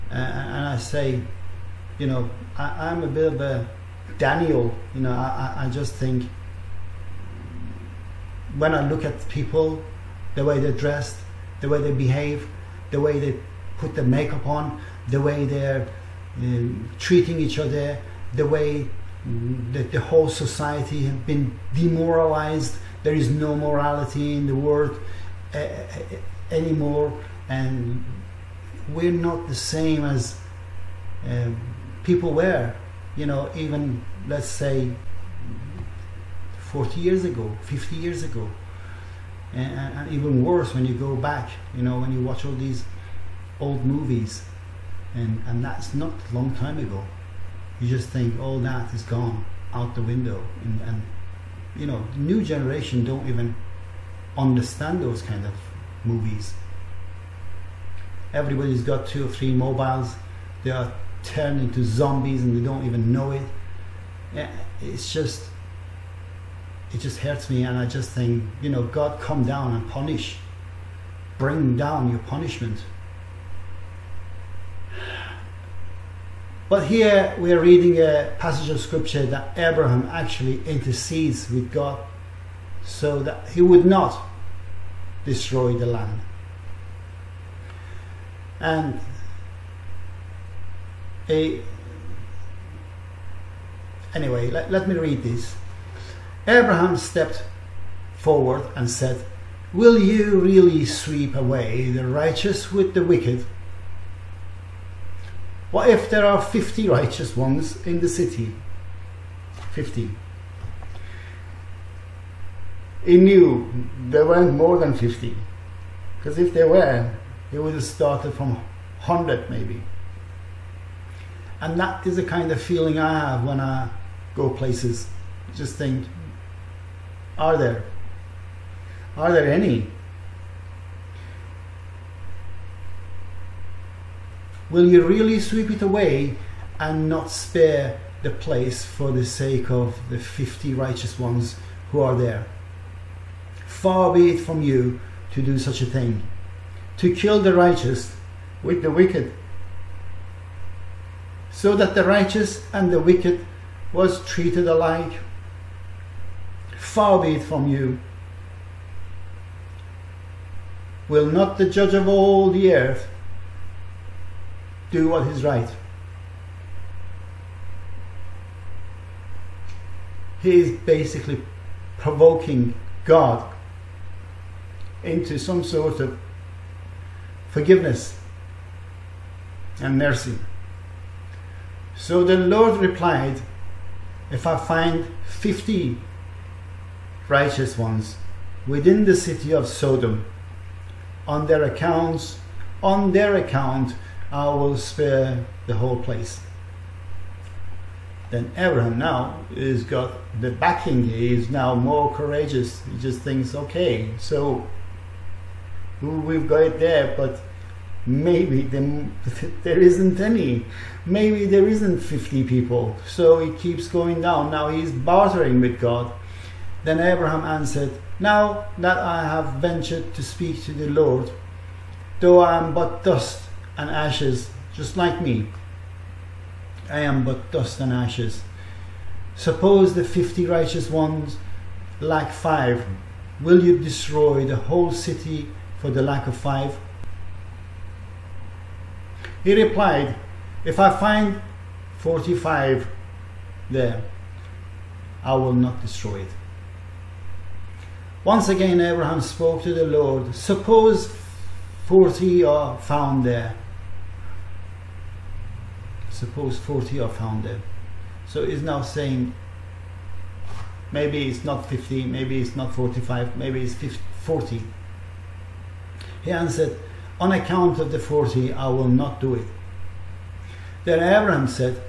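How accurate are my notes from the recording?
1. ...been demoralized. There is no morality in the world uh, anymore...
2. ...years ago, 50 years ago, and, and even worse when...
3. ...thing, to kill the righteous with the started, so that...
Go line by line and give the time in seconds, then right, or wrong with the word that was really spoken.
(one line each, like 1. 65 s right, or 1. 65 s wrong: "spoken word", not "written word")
1. 21 s right
2. 37 s right
3. 145 s wrong: "wicked", not "started".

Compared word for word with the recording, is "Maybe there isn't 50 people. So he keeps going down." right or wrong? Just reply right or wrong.
right.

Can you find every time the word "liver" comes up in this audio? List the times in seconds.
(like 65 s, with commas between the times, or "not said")
not said.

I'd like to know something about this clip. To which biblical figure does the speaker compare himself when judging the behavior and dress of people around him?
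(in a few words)
Daniel.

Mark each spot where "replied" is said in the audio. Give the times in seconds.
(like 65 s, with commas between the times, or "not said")
182 s, 239 s.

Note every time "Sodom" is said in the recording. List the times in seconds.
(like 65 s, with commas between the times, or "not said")
189 s.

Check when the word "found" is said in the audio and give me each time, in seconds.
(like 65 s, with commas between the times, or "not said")
252 s, 257 s.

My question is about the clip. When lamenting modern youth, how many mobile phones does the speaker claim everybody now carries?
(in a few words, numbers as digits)
2 or 3.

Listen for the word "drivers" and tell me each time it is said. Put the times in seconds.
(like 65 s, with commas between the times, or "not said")
not said.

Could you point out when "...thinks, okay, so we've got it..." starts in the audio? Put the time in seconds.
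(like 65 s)
203 s.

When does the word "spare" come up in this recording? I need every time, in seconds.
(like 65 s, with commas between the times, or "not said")
137 s, 194 s.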